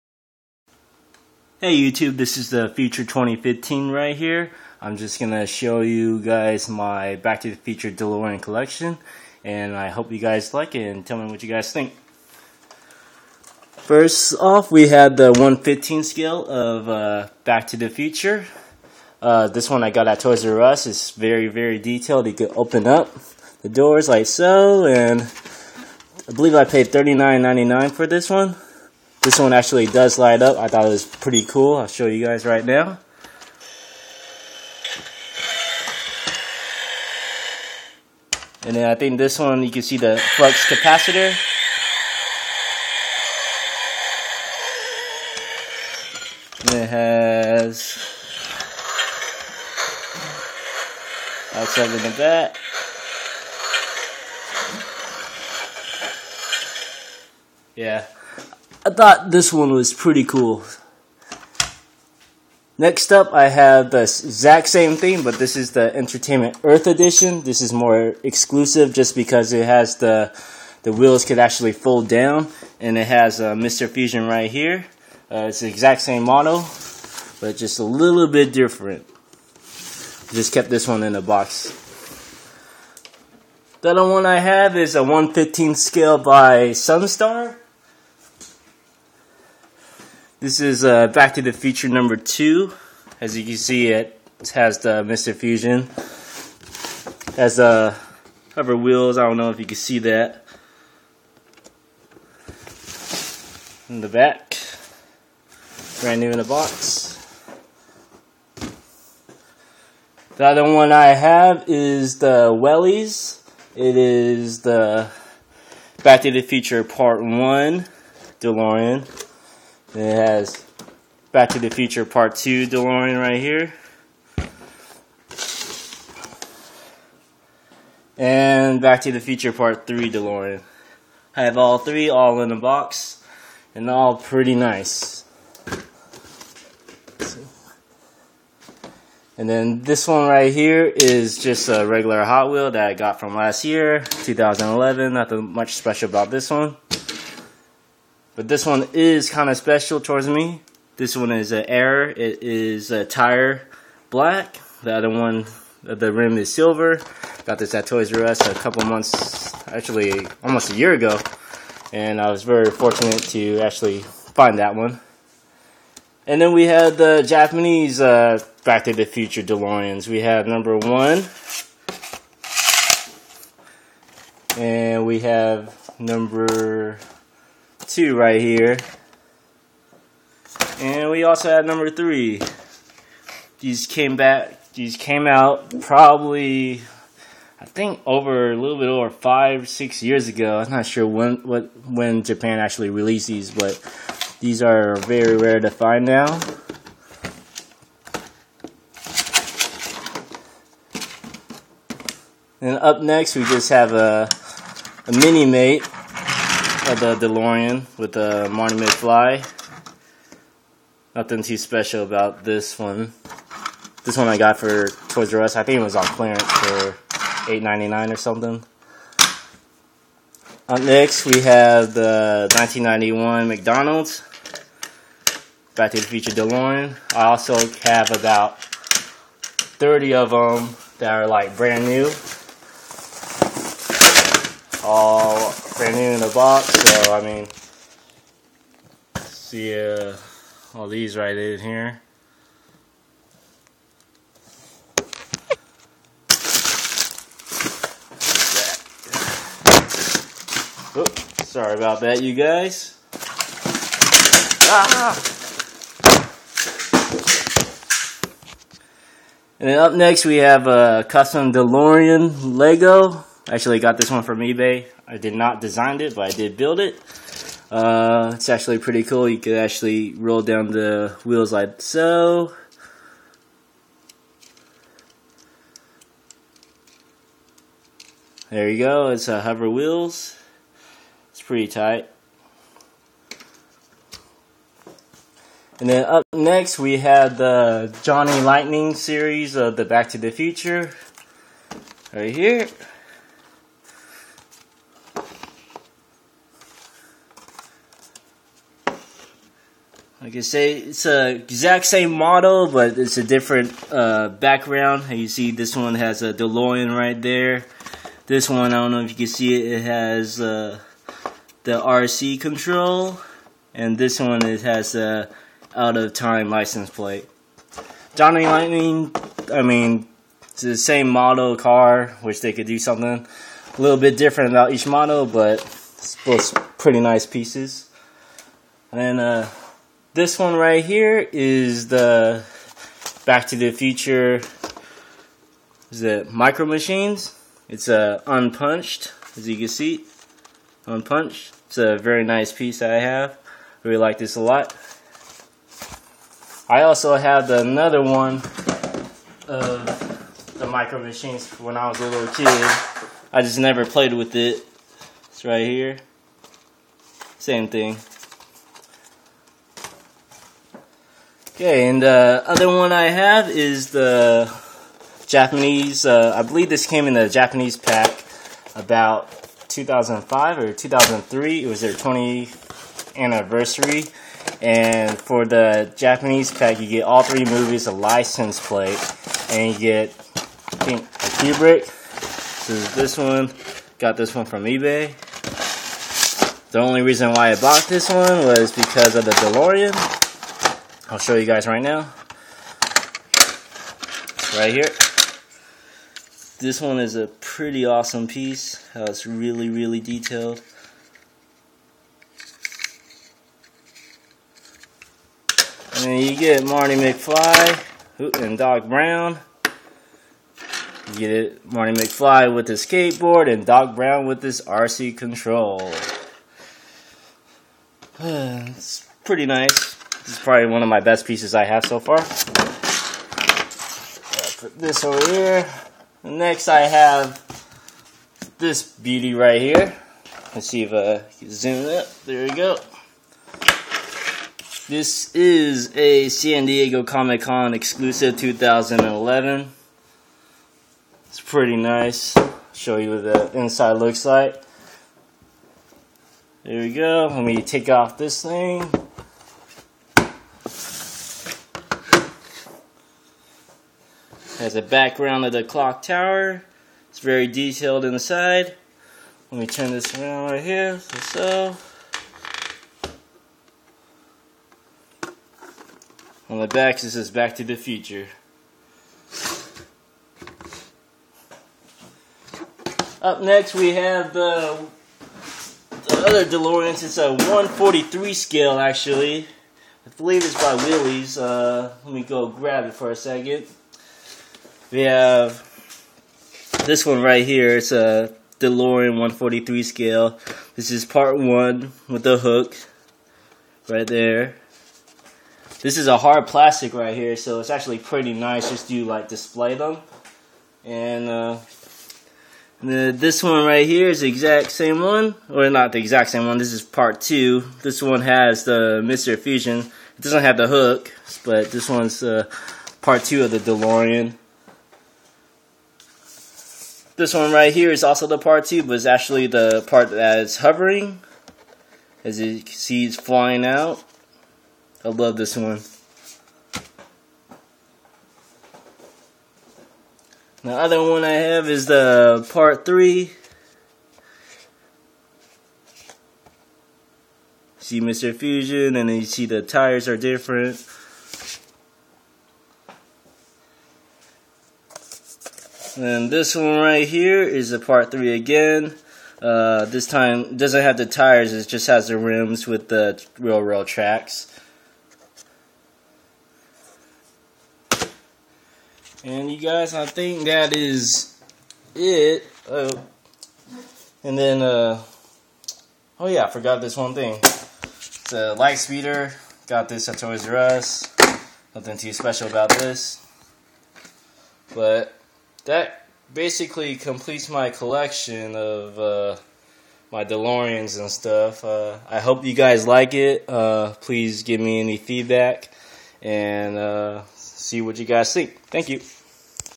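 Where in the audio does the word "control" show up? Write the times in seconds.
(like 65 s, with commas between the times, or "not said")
312 s, 415 s.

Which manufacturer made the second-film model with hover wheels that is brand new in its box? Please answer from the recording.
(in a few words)
Sunstar.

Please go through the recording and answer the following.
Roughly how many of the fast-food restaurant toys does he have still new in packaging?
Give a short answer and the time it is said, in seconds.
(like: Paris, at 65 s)
30, at 228 s.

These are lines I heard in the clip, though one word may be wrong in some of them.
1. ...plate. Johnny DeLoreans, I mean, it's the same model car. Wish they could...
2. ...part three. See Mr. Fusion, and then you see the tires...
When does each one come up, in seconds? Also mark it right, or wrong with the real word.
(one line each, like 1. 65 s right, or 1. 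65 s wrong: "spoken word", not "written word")
1. 316 s wrong: "Lightning", not "DeLoreans"
2. 532 s right.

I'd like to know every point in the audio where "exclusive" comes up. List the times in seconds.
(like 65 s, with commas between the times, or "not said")
68 s, 437 s.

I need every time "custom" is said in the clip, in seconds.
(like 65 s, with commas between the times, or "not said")
261 s.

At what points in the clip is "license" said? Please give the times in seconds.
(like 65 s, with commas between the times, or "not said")
316 s, 377 s.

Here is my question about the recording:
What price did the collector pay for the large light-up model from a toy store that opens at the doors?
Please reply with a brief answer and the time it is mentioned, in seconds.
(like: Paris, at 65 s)
$39.99, at 26 s.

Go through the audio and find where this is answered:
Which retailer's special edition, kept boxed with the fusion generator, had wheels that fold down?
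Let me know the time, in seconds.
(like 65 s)
65 s.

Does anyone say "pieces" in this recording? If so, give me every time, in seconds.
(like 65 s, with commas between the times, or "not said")
327 s, 342 s, 398 s, 421 s.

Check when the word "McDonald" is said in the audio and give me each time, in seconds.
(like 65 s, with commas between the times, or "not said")
223 s.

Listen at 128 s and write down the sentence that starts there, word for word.
And Back to the Future Part 3 DeLorean.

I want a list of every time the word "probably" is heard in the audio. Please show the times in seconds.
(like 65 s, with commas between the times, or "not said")
185 s, 420 s.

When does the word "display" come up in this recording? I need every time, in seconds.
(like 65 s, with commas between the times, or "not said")
499 s.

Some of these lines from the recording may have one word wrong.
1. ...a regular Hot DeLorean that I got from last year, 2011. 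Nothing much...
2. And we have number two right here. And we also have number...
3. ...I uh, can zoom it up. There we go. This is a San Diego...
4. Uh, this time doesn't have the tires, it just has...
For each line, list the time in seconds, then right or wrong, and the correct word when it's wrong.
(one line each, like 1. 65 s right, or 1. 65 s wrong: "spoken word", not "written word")
1. 141 s wrong: "Wheel", not "DeLorean"
2. 174 s right
3. 430 s right
4. 549 s right.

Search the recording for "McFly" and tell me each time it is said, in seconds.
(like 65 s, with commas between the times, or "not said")
208 s, 406 s, 411 s.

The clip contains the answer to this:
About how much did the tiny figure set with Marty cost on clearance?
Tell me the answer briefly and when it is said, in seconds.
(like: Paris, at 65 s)
$8.99, at 217 s.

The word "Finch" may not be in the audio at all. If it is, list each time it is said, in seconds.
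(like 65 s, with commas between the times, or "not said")
not said.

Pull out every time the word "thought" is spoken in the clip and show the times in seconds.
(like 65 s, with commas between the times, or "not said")
30 s, 58 s.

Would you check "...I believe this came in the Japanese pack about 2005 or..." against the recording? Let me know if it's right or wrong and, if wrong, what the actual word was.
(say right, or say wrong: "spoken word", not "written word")
right.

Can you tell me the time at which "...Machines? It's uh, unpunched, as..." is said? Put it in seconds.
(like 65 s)
336 s.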